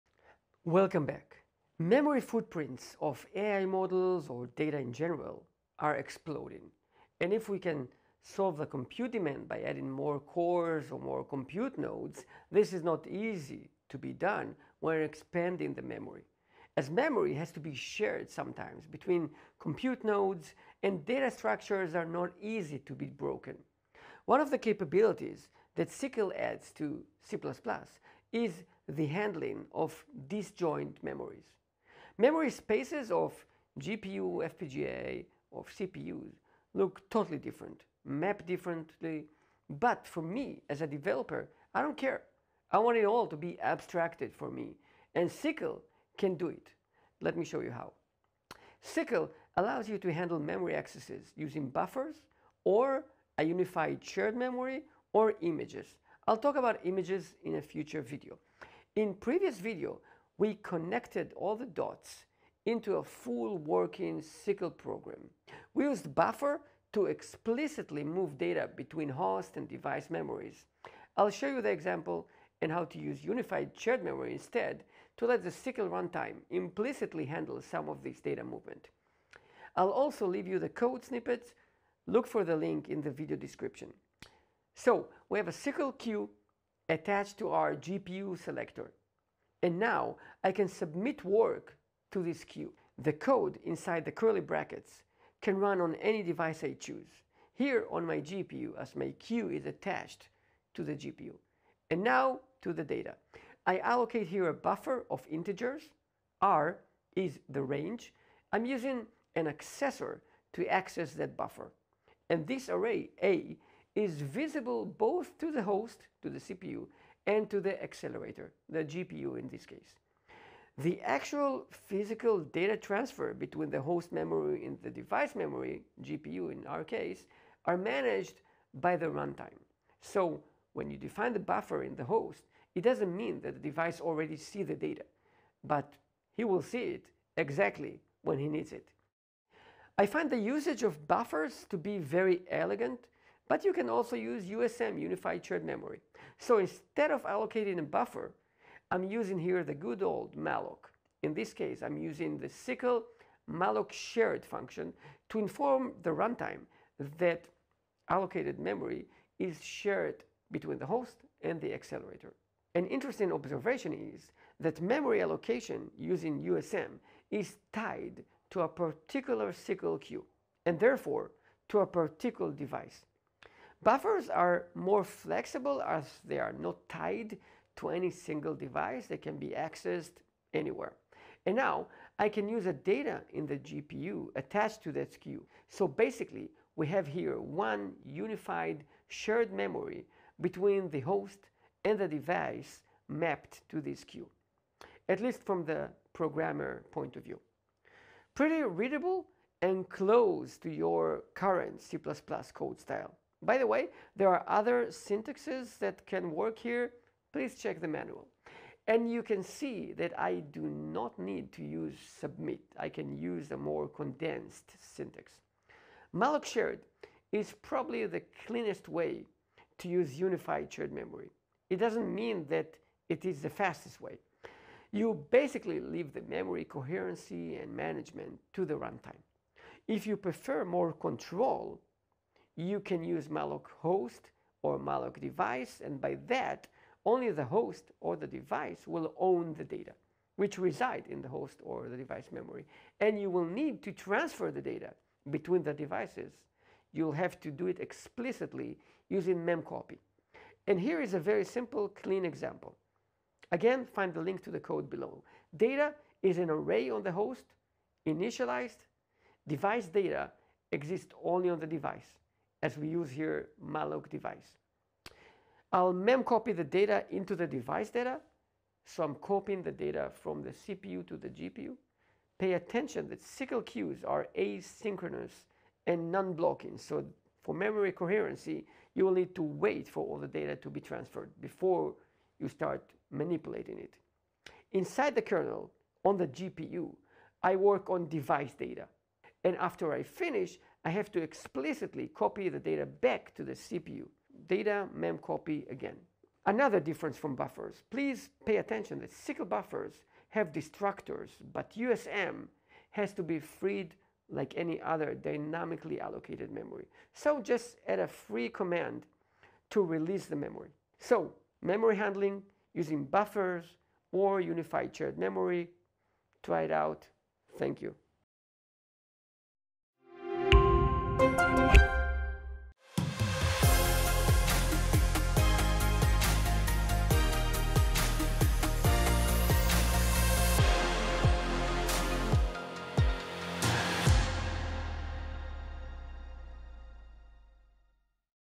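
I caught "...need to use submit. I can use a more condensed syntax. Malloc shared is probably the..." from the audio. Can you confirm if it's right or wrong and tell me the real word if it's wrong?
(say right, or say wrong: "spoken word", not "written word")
right.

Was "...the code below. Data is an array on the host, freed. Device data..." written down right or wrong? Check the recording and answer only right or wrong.
wrong.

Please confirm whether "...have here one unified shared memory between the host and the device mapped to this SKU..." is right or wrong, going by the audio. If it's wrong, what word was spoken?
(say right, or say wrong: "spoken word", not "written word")
right.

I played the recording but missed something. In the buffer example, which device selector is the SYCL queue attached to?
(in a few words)
GPU selector.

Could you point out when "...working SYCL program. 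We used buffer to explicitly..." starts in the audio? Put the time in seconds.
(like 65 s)
63 s.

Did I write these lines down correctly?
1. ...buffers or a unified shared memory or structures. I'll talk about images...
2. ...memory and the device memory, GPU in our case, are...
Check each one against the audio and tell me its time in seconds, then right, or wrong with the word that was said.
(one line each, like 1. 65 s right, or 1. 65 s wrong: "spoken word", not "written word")
1. 51 s wrong: "images", not "structures"
2. 124 s right.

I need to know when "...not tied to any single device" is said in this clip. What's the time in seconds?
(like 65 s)
176 s.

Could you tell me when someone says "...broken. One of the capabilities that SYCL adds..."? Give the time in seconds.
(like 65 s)
23 s.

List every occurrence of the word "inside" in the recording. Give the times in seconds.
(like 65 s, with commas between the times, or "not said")
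93 s, 284 s.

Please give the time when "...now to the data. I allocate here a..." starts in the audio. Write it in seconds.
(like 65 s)
102 s.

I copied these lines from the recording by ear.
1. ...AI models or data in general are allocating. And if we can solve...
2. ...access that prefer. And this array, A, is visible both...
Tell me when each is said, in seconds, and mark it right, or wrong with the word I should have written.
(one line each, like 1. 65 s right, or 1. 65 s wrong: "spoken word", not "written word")
1. 3 s wrong: "exploding", not "allocating"
2. 110 s wrong: "buffer", not "prefer".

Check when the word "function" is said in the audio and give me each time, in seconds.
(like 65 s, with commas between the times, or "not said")
154 s.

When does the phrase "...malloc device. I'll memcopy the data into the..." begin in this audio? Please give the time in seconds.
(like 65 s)
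263 s.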